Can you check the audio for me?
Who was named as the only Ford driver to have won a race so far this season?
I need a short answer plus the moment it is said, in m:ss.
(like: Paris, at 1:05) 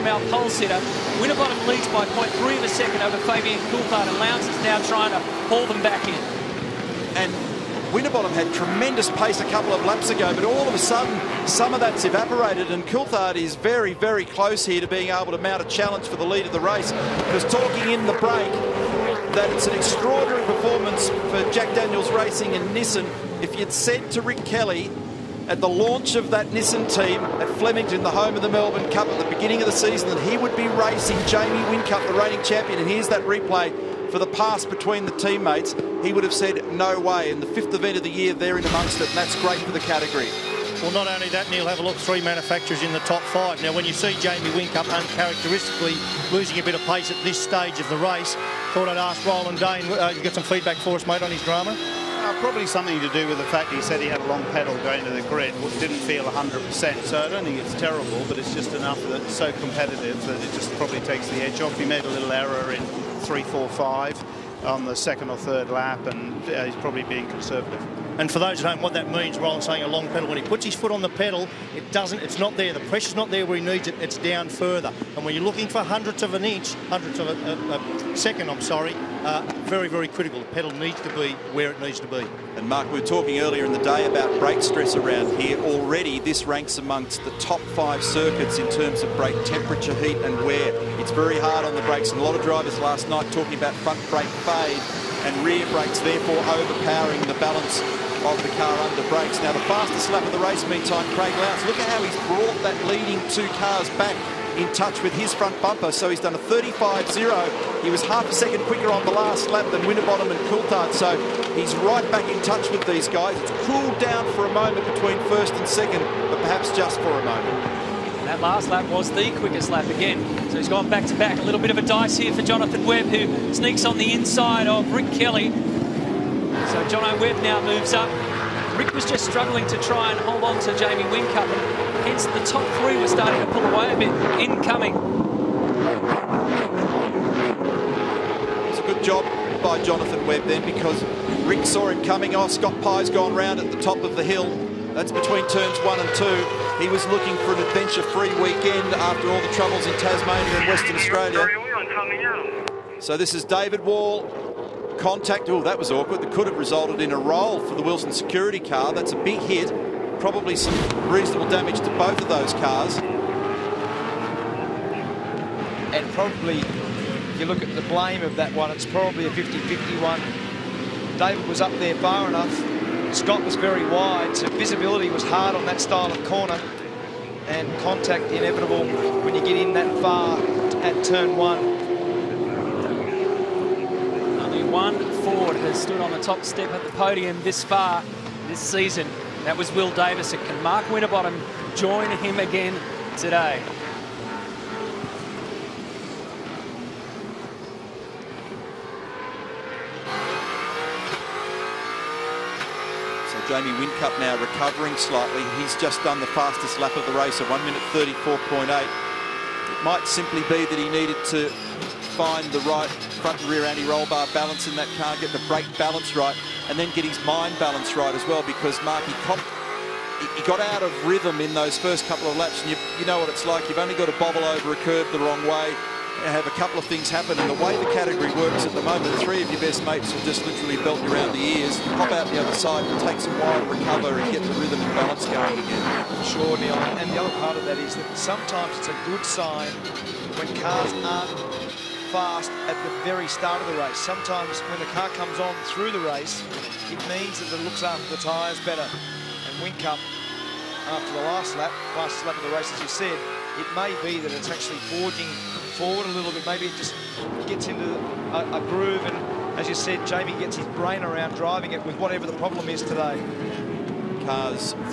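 Will Davison, at 3:09.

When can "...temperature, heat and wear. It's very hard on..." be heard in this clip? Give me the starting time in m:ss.
1:29.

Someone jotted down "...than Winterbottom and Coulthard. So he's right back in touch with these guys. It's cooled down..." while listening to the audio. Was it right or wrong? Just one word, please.
right.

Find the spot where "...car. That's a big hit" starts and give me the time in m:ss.
2:38.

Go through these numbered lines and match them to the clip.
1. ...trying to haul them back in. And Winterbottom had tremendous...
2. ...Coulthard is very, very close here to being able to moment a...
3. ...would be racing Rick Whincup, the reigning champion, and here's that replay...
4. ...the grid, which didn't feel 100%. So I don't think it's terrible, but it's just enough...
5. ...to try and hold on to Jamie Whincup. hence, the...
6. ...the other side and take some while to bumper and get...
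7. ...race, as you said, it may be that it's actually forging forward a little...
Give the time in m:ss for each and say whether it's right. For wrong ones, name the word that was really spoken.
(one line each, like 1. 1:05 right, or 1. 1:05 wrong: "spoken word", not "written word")
1. 0:04 right
2. 0:12 wrong: "mount", not "moment"
3. 0:30 wrong: "Jamie", not "Rick"
4. 0:55 right
5. 2:09 right
6. 3:52 wrong: "recover", not "bumper"
7. 4:12 right.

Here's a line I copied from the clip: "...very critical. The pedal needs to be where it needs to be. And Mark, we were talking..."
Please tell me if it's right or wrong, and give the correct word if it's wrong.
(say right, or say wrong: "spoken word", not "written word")
right.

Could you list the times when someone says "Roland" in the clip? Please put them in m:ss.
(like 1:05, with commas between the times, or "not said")
0:49, 1:09.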